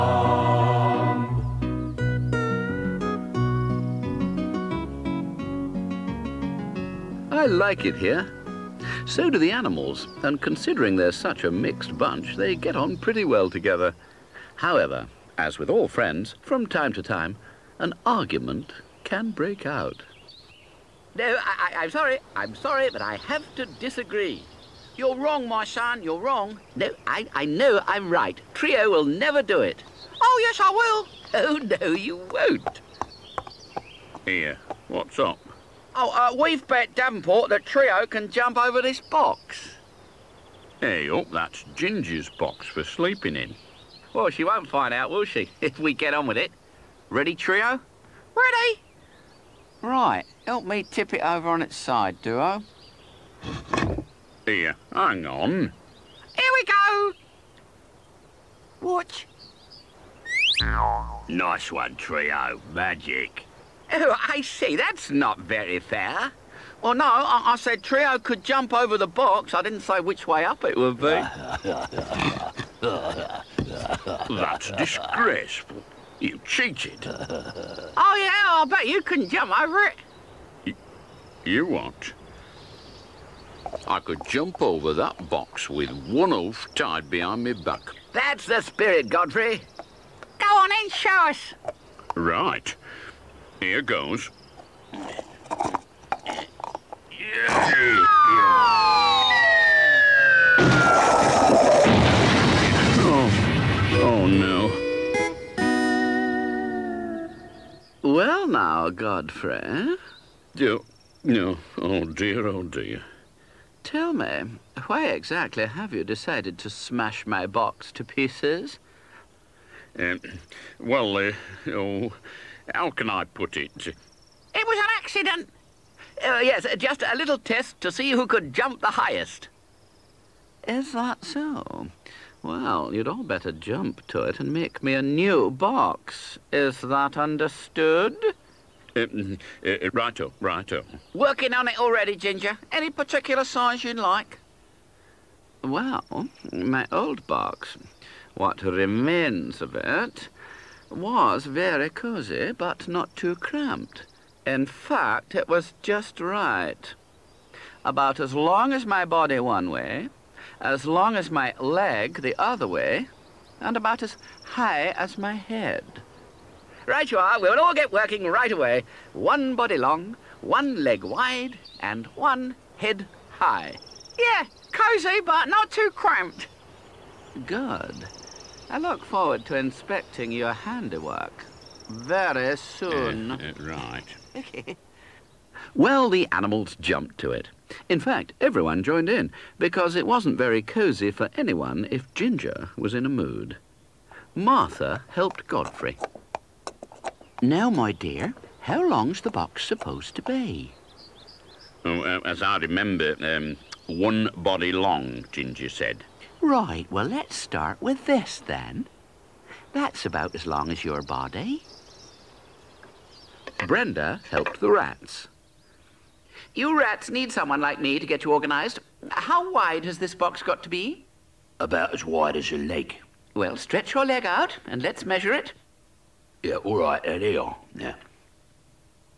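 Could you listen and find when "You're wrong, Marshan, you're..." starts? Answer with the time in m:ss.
0:24.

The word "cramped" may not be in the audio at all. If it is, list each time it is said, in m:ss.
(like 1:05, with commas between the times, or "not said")
2:33, 2:55.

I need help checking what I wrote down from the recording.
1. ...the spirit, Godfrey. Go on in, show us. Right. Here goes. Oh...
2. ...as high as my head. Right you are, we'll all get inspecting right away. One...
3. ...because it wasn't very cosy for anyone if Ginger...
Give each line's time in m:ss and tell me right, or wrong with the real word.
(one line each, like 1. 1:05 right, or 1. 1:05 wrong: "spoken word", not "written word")
1. 1:28 right
2. 2:44 wrong: "working", not "inspecting"
3. 3:09 right.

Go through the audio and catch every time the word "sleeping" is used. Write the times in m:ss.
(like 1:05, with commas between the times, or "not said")
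0:42.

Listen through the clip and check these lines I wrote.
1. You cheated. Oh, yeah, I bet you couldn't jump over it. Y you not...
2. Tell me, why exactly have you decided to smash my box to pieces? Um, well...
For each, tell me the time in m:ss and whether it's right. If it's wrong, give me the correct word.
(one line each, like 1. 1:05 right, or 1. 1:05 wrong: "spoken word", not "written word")
1. 1:16 right
2. 1:53 right.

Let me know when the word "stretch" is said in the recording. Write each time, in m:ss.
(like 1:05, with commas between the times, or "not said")
3:43.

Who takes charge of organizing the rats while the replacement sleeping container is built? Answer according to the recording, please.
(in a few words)
Brenda.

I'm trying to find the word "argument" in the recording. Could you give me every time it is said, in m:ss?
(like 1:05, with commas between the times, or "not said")
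0:18.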